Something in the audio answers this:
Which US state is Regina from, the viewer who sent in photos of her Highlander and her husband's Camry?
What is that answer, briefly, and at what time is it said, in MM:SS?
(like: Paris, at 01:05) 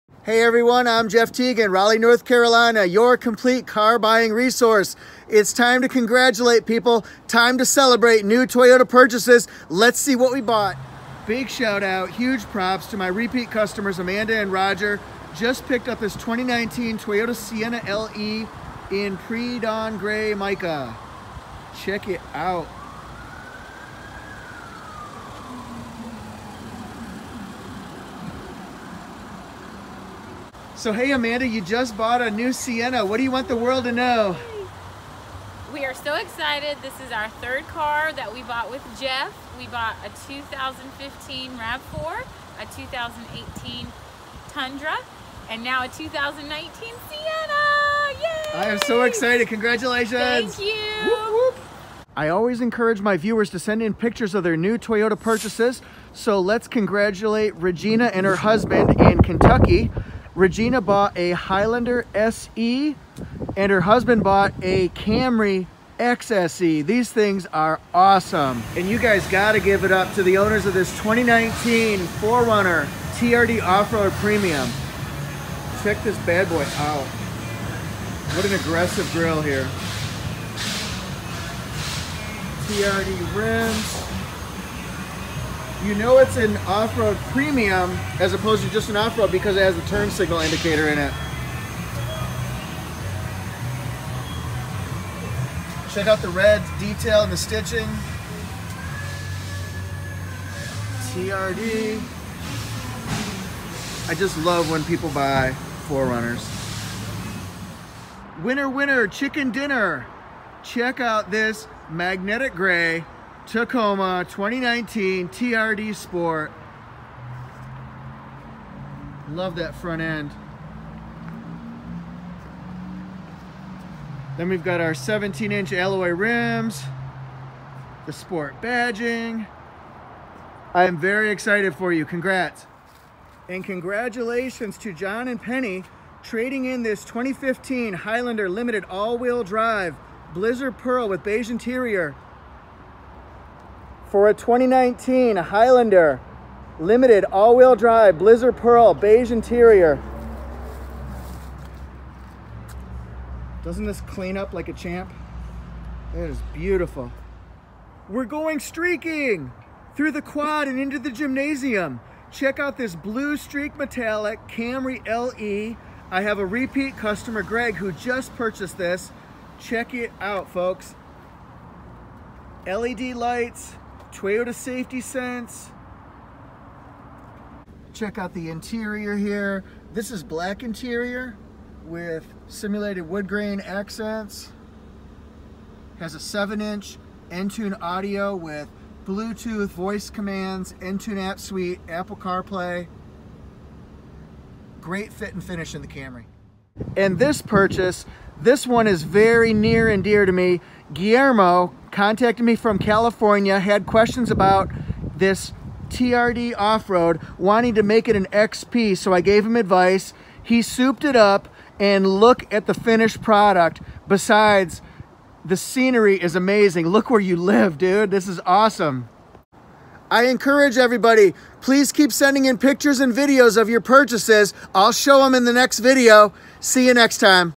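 Kentucky, at 00:59.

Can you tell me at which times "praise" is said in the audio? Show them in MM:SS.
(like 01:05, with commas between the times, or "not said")
not said.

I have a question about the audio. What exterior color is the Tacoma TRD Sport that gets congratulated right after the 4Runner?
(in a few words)
Magnetic gray.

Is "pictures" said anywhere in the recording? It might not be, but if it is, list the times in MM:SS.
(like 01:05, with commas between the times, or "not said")
00:53, 03:42.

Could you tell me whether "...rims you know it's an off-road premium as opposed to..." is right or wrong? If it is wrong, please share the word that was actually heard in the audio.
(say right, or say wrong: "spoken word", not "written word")
right.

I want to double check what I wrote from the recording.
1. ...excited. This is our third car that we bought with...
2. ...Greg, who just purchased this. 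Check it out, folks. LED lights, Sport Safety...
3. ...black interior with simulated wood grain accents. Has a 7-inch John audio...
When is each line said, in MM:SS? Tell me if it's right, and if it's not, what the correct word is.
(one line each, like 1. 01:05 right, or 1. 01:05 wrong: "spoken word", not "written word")
1. 00:36 right
2. 02:47 wrong: "Toyota", not "Sport"
3. 03:00 wrong: "Entune", not "John".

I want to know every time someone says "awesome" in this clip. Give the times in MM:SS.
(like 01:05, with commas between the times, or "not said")
01:07, 03:38.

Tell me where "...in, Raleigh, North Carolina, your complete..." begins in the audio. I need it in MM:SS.
00:01.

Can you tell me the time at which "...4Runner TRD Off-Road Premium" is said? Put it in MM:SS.
01:11.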